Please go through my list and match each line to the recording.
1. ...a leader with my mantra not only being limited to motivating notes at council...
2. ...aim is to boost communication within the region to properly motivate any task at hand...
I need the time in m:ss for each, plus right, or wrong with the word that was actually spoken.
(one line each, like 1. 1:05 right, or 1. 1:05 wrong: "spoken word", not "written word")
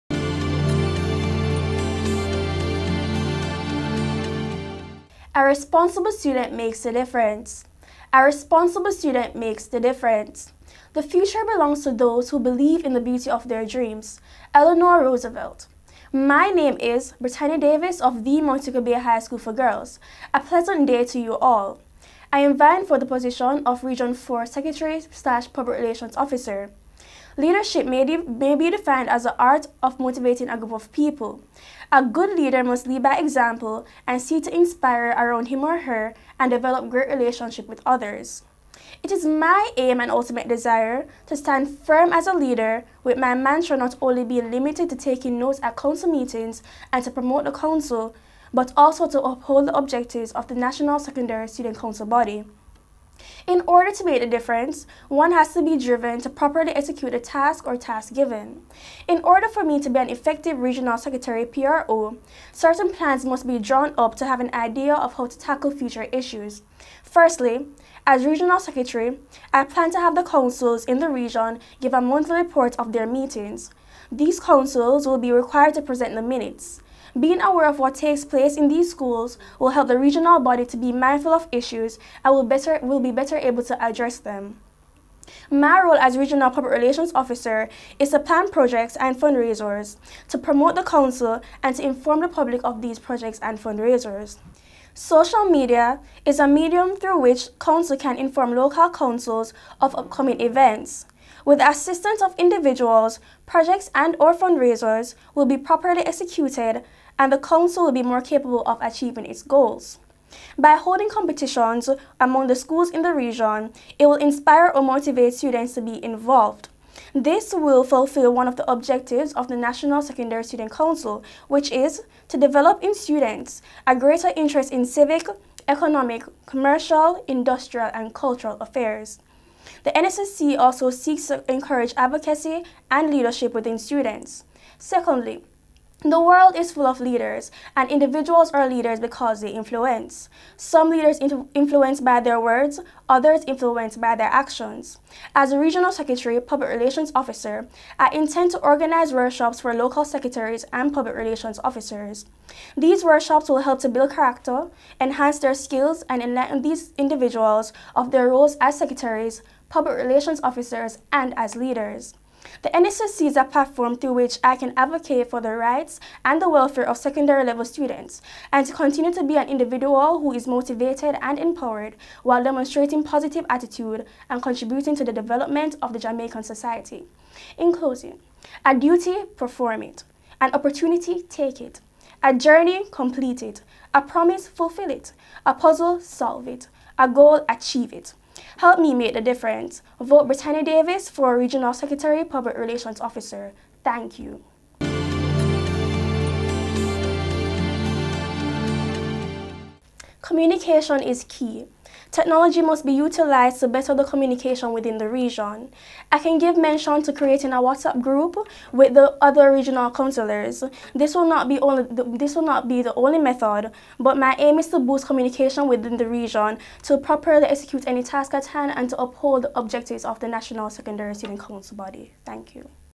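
1. 0:42 wrong: "taking", not "motivating"
2. 3:34 wrong: "execute", not "motivate".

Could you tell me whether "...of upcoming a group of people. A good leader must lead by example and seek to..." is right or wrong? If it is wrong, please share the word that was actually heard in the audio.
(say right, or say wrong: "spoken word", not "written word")
wrong: "motivating", not "upcoming".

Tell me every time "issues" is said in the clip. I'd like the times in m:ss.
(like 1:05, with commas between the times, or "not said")
1:06, 1:21.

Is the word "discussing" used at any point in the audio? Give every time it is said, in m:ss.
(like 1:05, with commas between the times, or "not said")
not said.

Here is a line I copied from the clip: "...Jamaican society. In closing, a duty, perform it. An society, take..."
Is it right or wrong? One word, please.
wrong.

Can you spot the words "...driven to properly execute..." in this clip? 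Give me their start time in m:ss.
0:55.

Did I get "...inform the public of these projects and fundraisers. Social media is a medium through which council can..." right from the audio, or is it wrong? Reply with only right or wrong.
right.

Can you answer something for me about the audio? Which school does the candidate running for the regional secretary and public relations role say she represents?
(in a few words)
Montego Bay High School for Girls.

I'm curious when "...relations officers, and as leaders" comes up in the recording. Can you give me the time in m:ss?
2:39.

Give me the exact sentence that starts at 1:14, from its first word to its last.
These councils will be required to present the minutes.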